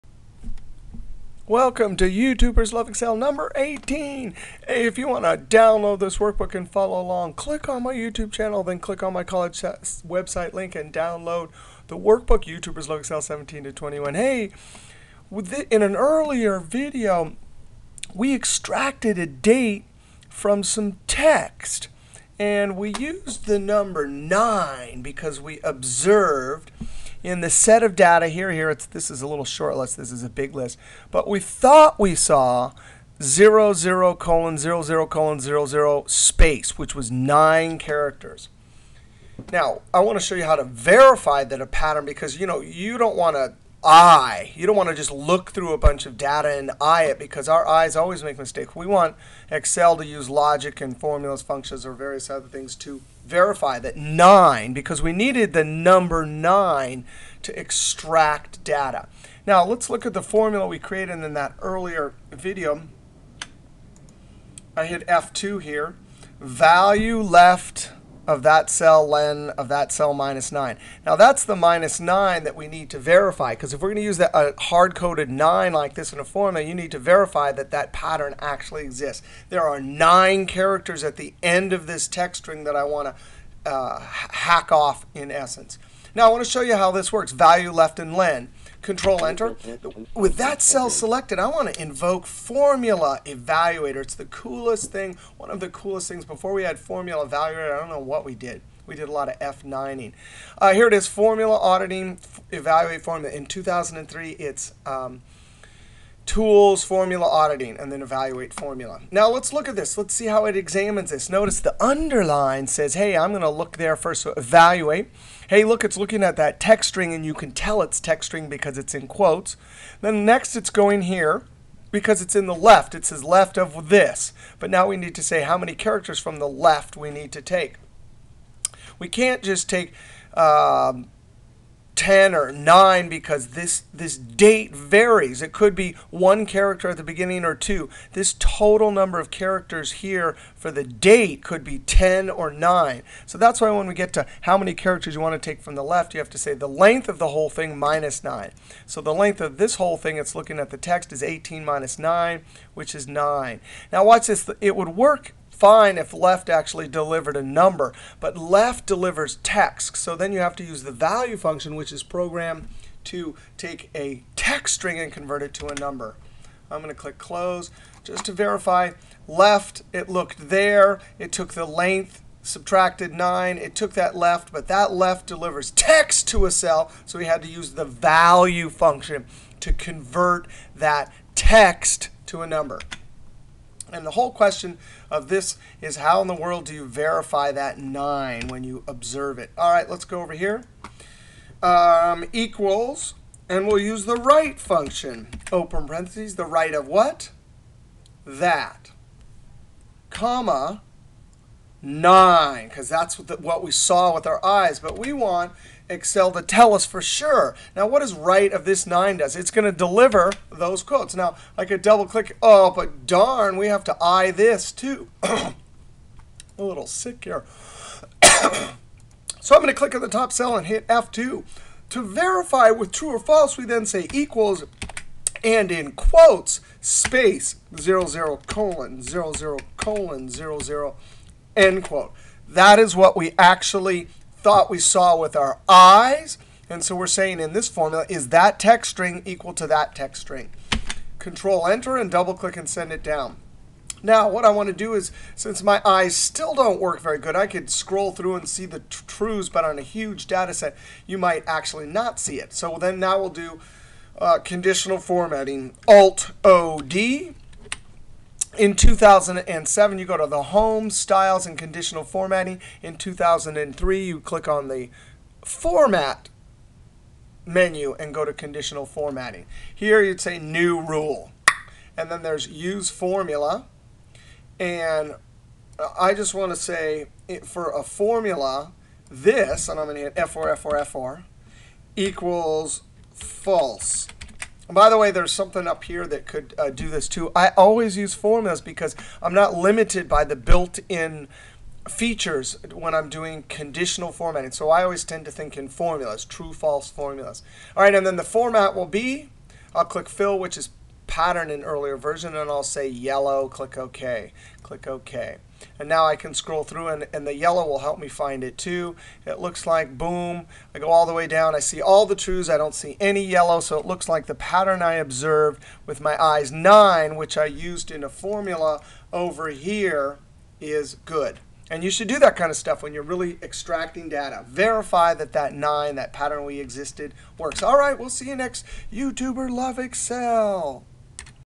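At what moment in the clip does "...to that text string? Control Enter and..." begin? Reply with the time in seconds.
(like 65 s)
239 s.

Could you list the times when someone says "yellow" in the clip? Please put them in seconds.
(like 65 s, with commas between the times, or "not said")
302 s, 307 s, 313 s.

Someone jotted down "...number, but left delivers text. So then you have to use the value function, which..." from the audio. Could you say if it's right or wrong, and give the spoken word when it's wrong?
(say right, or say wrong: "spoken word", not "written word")
right.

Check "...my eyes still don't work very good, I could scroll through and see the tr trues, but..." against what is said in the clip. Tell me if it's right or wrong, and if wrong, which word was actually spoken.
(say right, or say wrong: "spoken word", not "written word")
right.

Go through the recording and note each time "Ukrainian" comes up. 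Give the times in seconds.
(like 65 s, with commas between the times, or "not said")
not said.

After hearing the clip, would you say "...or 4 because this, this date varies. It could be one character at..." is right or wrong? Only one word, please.
wrong.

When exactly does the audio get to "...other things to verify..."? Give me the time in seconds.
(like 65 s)
52 s.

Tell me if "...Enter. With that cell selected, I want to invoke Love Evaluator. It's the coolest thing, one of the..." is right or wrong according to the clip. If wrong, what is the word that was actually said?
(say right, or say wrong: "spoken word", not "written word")
wrong: "Formula", not "Love".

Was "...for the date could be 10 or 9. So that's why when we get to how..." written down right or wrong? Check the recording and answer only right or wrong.
right.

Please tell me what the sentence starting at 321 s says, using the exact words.
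And you should do that kind of stuff when you're really extracting data.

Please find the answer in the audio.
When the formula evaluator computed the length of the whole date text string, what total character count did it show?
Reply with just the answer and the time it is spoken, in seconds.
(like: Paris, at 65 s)
18, at 151 s.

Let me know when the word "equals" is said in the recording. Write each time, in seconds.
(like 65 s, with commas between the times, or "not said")
192 s, 224 s, 239 s, 281 s.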